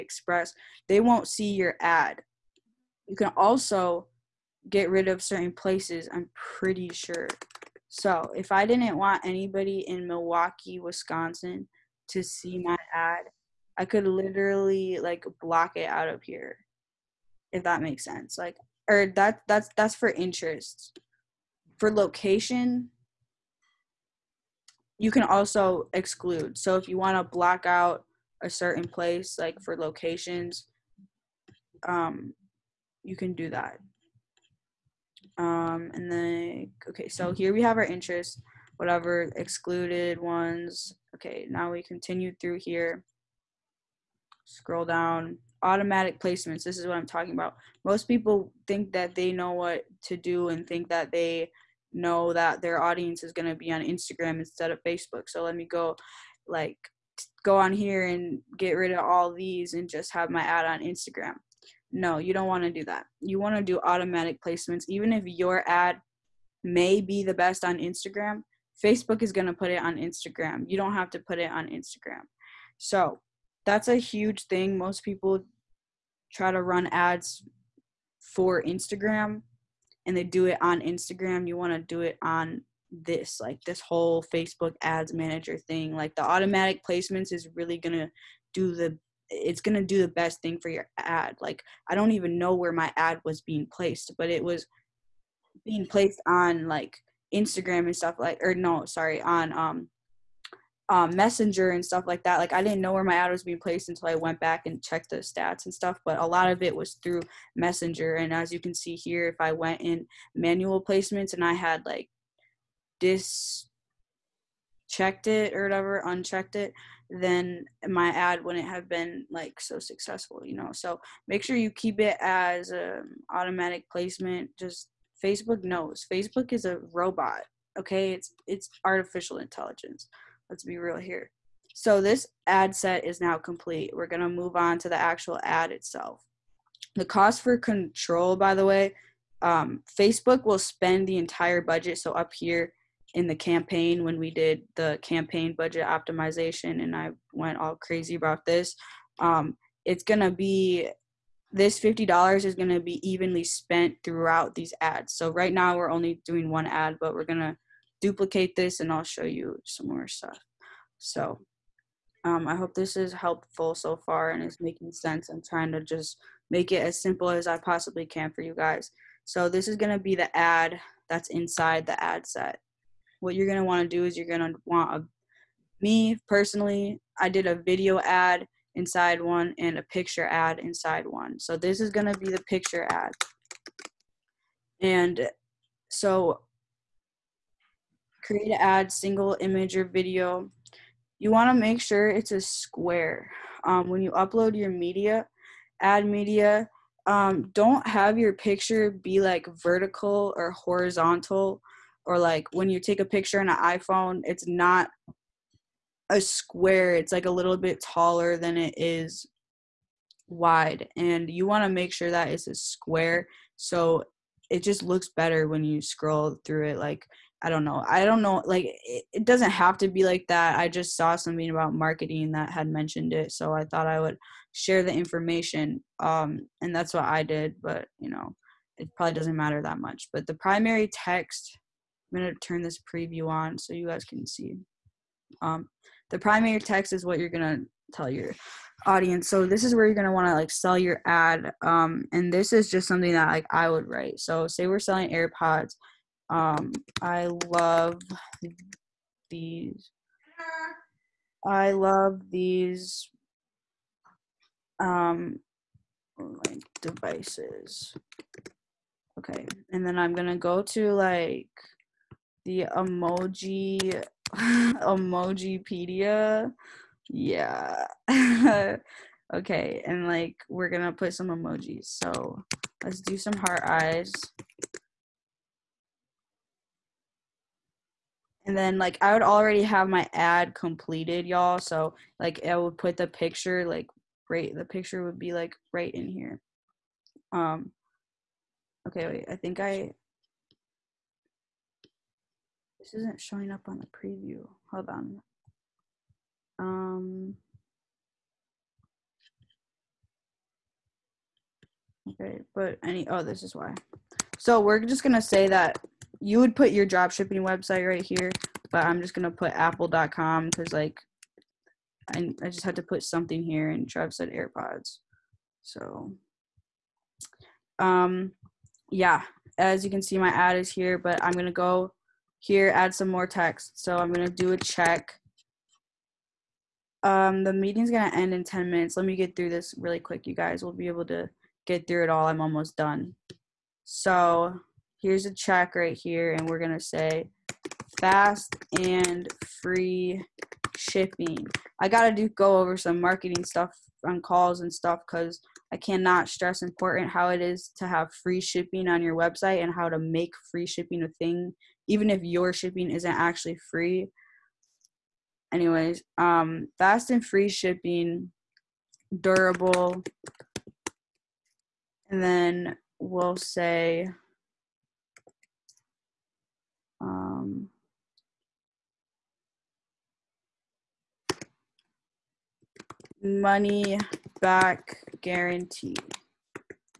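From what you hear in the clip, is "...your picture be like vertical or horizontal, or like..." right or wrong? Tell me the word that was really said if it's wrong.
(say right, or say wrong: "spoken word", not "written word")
right.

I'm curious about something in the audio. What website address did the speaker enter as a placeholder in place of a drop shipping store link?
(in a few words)
apple.com.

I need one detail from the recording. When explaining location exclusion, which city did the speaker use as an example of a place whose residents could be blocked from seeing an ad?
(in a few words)
Milwaukee.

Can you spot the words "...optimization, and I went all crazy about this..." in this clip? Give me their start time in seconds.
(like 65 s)
145 s.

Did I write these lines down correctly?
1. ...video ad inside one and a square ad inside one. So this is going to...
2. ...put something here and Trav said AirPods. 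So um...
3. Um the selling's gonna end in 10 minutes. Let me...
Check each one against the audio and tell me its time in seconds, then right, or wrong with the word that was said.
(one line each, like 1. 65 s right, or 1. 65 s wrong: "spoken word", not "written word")
1. 177 s wrong: "picture", not "square"
2. 312 s right
3. 327 s wrong: "meeting", not "selling".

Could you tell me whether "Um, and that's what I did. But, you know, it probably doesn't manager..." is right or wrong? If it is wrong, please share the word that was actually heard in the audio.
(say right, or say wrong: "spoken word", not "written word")
wrong: "matter", not "manager".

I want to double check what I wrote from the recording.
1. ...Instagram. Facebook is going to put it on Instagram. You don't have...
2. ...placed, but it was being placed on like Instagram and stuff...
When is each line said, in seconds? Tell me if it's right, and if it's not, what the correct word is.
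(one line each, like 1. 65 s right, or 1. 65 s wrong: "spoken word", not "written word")
1. 67 s right
2. 93 s right.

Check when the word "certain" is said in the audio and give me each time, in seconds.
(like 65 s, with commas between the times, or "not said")
5 s, 28 s.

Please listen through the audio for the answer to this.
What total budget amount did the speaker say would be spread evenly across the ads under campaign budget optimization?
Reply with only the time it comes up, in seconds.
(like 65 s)
151 s.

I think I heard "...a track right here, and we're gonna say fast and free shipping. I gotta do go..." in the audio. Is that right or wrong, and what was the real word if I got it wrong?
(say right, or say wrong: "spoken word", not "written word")
right.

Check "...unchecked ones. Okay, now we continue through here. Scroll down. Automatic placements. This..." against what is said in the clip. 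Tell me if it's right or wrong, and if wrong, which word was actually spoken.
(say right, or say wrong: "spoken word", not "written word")
wrong: "excluded", not "unchecked".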